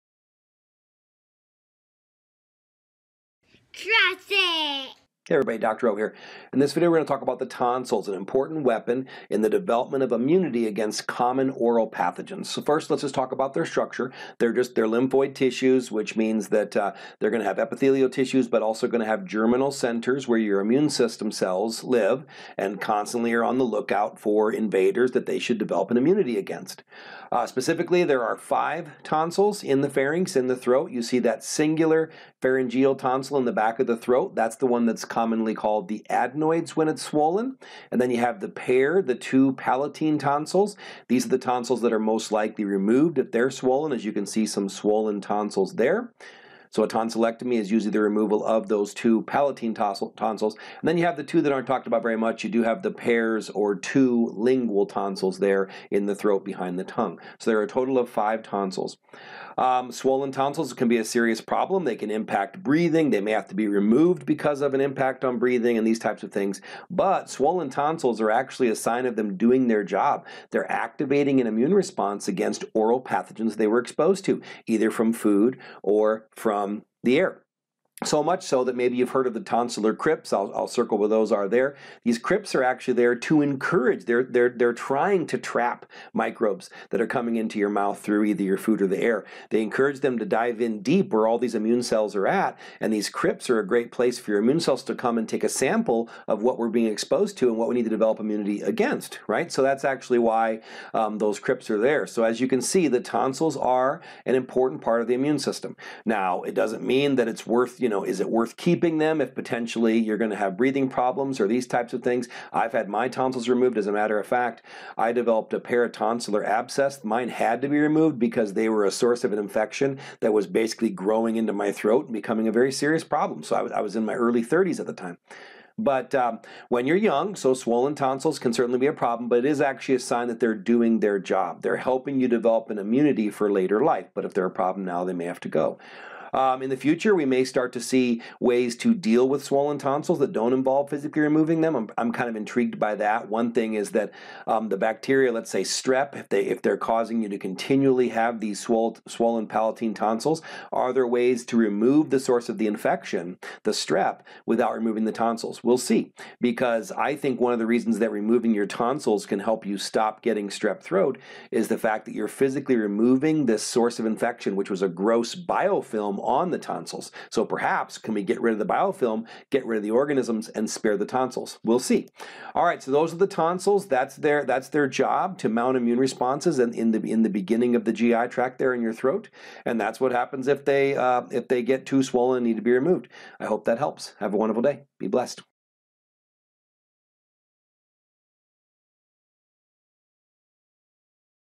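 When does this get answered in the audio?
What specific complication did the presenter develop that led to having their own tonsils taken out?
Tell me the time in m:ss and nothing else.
1:55.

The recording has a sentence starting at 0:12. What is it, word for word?
So first let's just talk about their structure.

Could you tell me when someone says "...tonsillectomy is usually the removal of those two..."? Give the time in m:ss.
0:46.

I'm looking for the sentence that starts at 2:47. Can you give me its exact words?
So perhaps can we get rid of the biofilm, get rid of the organisms, and spare the tonsils?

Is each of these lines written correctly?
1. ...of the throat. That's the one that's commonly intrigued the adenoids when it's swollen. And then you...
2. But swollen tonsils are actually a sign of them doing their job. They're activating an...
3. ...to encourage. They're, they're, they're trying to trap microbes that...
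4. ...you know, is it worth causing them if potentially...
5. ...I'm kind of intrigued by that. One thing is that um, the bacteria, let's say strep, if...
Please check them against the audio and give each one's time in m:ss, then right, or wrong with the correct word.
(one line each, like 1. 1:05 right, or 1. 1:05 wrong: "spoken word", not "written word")
1. 0:33 wrong: "called", not "intrigued"
2. 1:06 right
3. 1:23 right
4. 1:47 wrong: "keeping", not "causing"
5. 2:21 right.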